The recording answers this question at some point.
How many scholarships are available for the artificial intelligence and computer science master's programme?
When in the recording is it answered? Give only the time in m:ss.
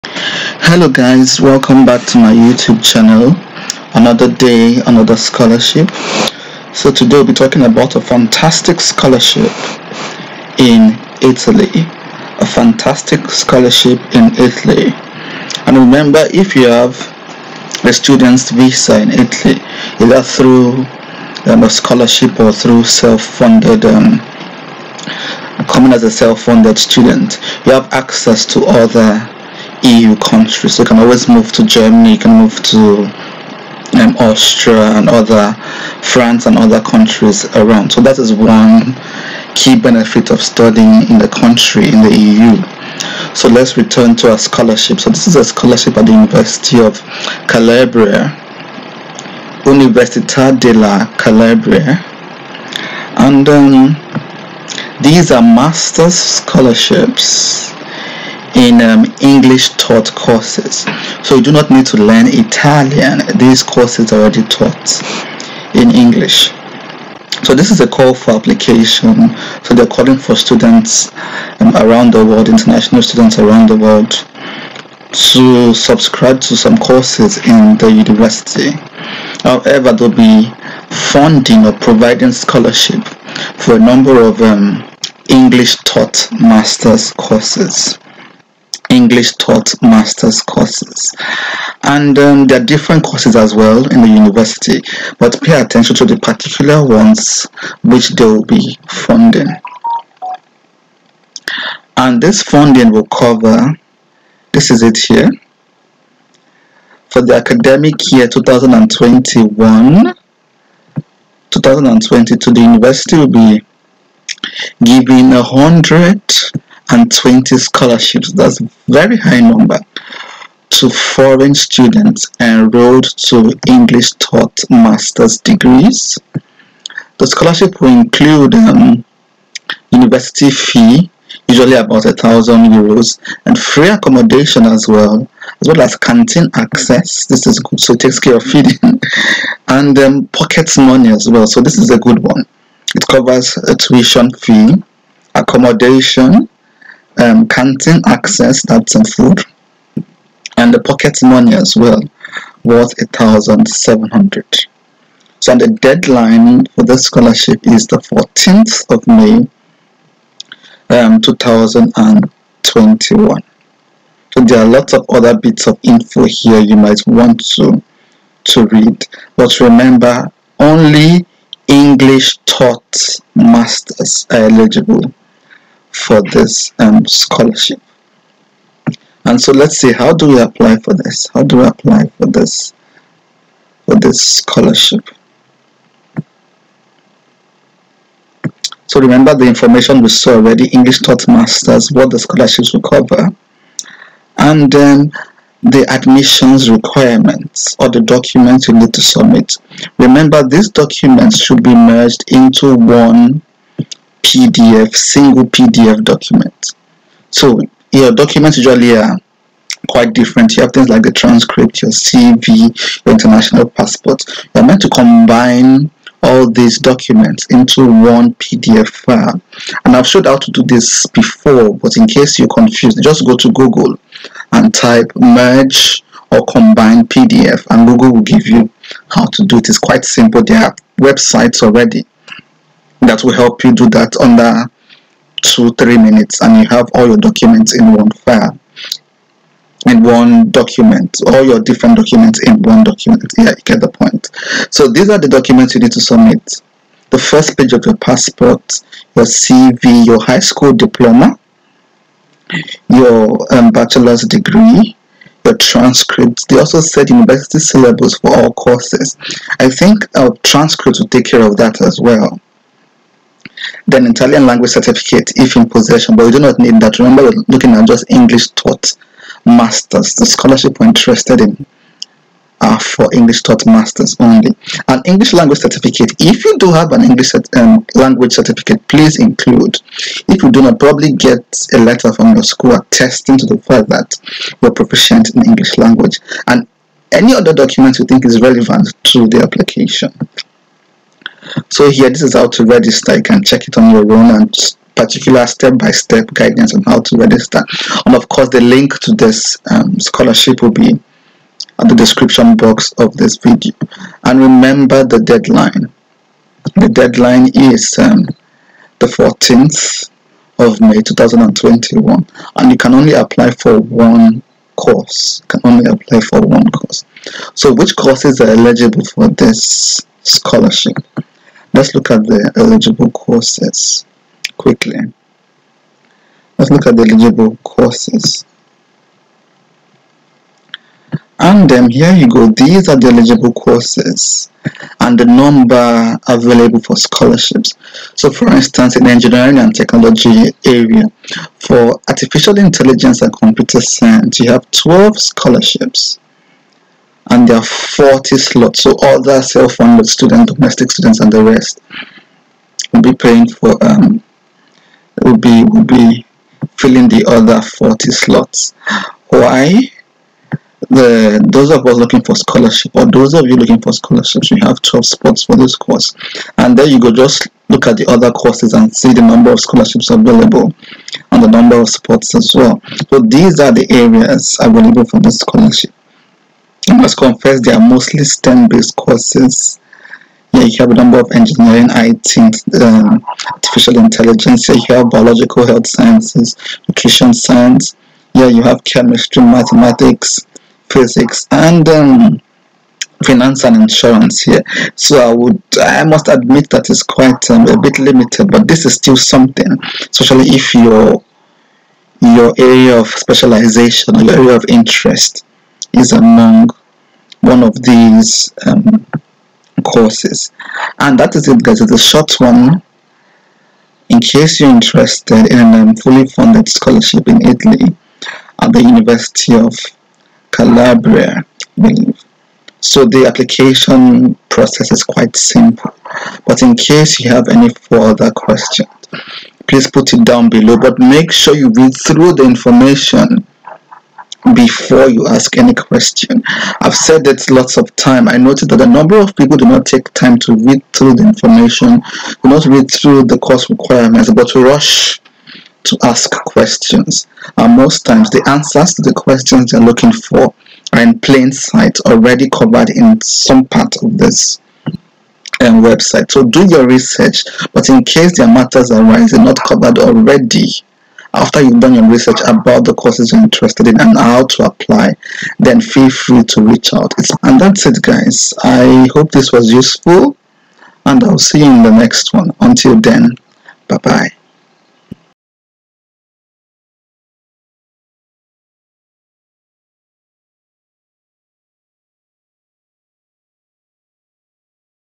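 5:44.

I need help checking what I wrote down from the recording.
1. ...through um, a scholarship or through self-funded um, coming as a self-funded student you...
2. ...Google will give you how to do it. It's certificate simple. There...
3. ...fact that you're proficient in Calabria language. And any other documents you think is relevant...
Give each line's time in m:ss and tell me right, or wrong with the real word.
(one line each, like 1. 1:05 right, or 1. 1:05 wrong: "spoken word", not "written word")
1. 0:20 right
2. 3:47 wrong: "quite", not "certificate"
3. 4:43 wrong: "English", not "Calabria".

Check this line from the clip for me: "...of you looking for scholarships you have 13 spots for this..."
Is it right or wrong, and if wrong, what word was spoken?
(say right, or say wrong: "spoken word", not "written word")
wrong: "12", not "13".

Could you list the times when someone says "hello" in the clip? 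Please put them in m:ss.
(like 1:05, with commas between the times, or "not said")
0:00.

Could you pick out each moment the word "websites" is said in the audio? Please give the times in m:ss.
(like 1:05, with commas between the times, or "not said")
3:50, 7:35.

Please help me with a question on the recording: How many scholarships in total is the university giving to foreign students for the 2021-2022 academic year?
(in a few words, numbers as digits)
120.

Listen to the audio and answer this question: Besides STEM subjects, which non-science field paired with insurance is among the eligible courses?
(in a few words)
Finance.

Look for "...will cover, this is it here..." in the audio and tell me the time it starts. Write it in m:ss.
1:42.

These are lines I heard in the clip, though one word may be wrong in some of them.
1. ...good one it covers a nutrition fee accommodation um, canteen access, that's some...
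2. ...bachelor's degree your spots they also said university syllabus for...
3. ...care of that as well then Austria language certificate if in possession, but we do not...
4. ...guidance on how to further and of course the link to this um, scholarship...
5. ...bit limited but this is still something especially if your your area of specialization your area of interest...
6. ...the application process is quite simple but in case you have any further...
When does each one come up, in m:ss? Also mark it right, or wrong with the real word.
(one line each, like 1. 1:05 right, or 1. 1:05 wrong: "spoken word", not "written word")
1. 2:21 wrong: "tuition", not "nutrition"
2. 4:13 wrong: "transcripts", not "spots"
3. 4:21 wrong: "Italian", not "Austria"
4. 4:56 wrong: "register", not "further"
5. 6:37 right
6. 7:03 right.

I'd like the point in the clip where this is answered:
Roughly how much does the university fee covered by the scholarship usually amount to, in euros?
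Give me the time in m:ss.
2:11.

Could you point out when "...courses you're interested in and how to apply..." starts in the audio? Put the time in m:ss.
7:42.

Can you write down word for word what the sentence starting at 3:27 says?
So your documents usually are quite different.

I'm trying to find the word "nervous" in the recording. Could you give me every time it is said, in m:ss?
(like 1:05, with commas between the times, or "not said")
not said.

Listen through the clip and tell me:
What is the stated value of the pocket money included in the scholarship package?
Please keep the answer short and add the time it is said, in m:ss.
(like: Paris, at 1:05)
1,700, at 2:33.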